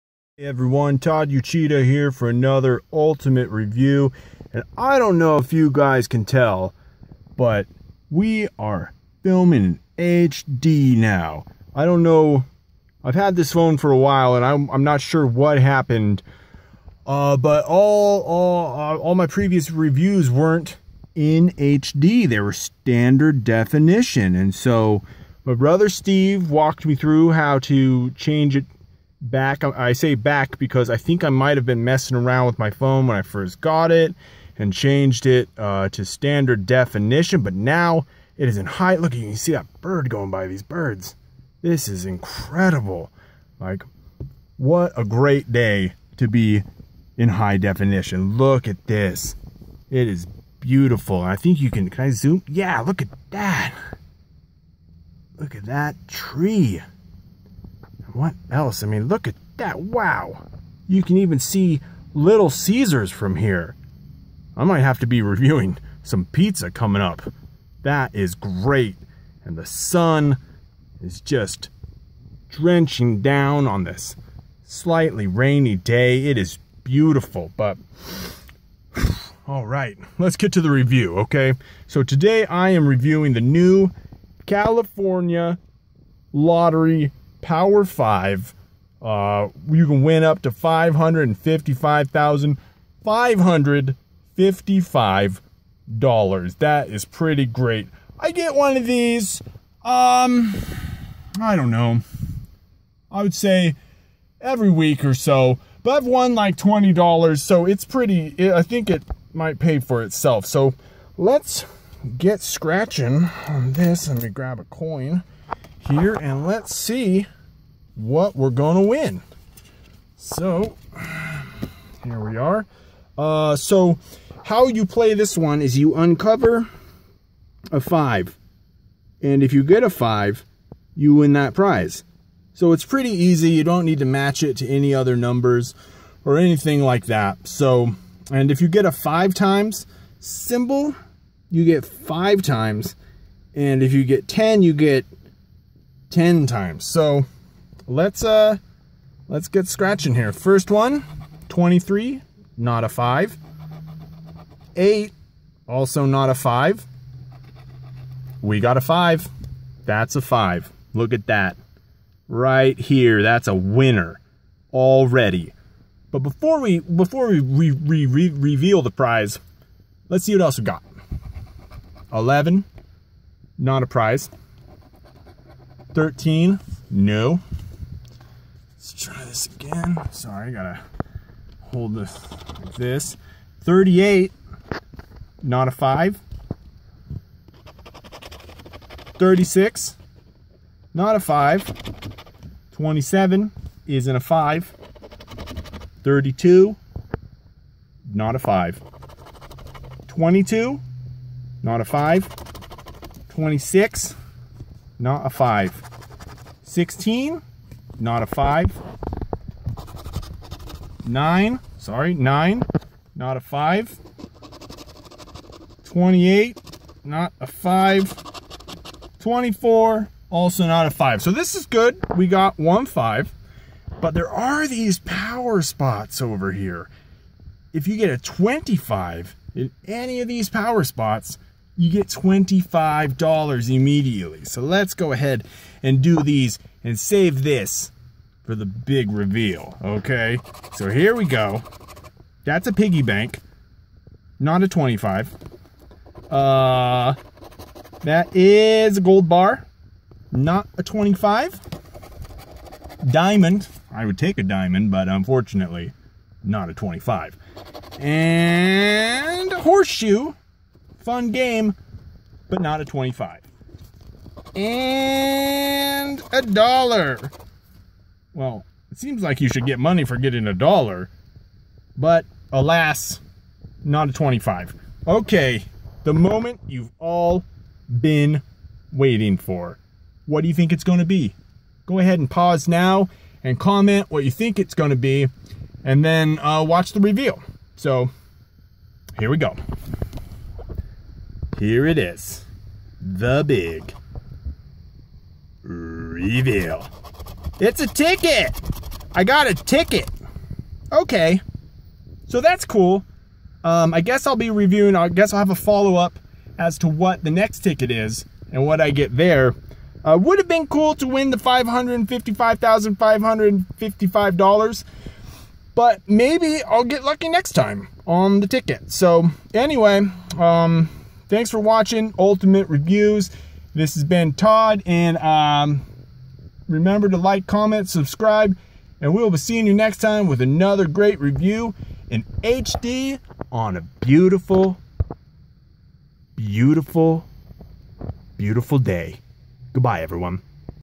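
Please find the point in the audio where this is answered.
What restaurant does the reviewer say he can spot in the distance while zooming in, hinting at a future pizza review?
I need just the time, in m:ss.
1:02.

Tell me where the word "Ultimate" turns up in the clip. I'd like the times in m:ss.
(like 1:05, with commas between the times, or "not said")
0:02, 5:22.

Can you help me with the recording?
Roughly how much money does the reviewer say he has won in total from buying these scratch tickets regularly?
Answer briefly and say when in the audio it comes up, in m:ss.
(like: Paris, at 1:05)
$20, at 1:46.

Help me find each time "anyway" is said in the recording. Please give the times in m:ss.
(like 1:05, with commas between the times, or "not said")
5:19.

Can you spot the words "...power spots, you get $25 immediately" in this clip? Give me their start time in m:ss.
3:50.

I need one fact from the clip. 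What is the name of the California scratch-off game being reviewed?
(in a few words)
Power 5.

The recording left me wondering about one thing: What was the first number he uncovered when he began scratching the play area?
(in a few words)
23.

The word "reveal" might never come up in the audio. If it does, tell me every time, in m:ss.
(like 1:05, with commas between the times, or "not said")
2:48, 3:59, 4:46, 4:55.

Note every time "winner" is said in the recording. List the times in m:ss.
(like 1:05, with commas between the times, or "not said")
2:43.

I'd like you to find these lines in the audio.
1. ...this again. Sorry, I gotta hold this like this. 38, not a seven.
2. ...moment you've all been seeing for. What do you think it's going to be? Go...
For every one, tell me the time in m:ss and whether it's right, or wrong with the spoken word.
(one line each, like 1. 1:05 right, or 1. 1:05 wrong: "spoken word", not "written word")
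1. 2:59 wrong: "five", not "seven"
2. 4:36 wrong: "waiting", not "seeing".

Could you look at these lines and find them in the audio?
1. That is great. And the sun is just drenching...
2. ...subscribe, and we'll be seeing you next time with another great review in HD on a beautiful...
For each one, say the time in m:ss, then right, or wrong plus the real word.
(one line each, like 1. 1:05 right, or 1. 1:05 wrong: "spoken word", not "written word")
1. 1:07 right
2. 5:27 right.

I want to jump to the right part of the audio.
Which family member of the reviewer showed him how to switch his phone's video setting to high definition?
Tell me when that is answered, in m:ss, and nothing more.
0:25.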